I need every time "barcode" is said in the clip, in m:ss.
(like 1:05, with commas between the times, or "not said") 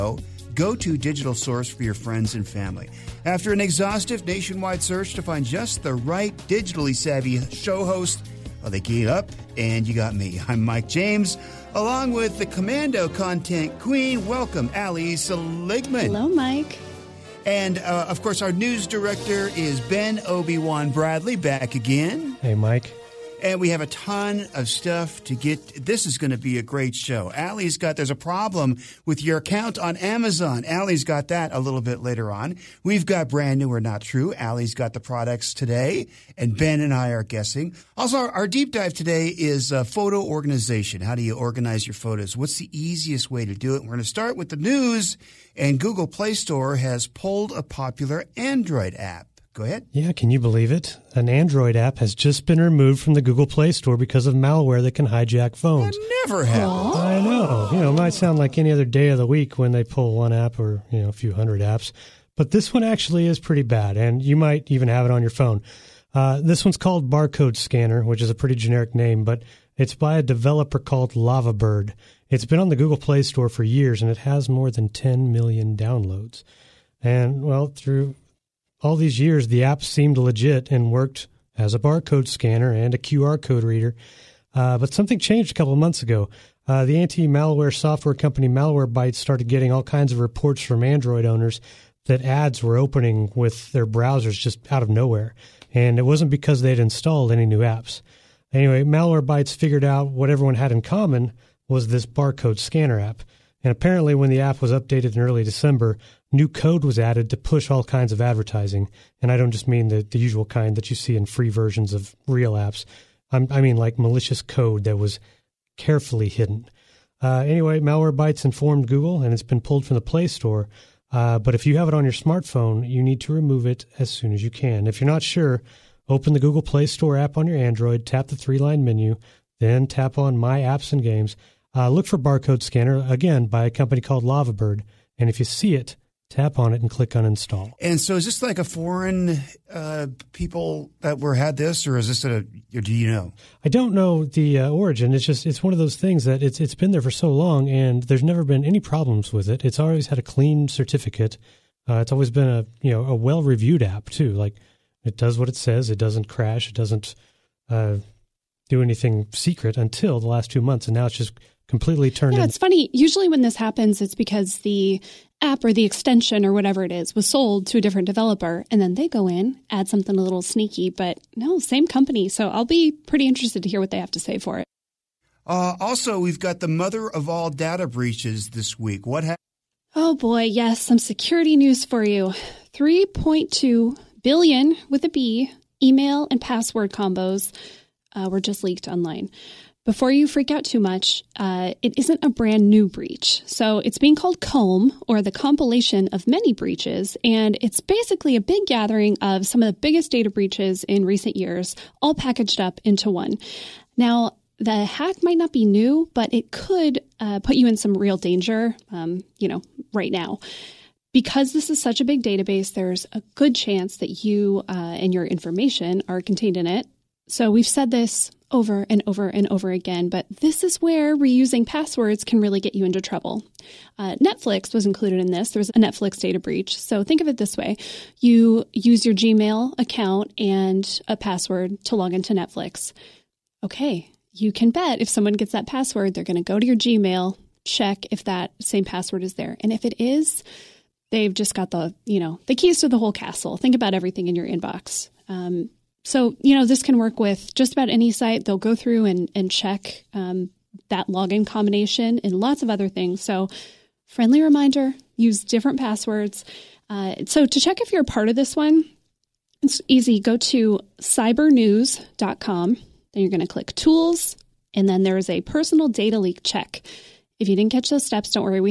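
1:07, 1:21, 1:42, 2:12.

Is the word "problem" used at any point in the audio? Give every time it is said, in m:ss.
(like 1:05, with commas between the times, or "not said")
0:28, 2:28.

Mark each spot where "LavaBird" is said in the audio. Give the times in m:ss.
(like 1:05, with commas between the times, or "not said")
1:11, 2:14.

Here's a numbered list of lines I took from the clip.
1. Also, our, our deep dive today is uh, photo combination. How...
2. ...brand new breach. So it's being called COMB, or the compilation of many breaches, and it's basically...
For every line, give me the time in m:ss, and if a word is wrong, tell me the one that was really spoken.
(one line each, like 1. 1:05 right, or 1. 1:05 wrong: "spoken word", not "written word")
1. 0:37 wrong: "organization", not "combination"
2. 3:12 right.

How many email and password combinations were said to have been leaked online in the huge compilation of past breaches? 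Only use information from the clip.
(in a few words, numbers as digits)
3.2 billion.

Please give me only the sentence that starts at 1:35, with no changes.
And it wasn't because they'd installed any new apps.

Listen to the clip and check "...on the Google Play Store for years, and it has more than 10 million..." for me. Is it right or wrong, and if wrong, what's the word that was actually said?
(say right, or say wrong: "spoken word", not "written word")
right.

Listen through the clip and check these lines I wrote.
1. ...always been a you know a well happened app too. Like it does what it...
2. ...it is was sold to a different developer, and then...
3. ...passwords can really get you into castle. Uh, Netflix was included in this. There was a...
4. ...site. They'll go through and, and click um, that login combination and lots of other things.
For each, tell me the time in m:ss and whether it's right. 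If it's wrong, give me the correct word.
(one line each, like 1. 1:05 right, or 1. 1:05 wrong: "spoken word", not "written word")
1. 2:32 wrong: "reviewed", not "happened"
2. 2:46 right
3. 3:41 wrong: "trouble", not "castle"
4. 4:08 wrong: "check", not "click".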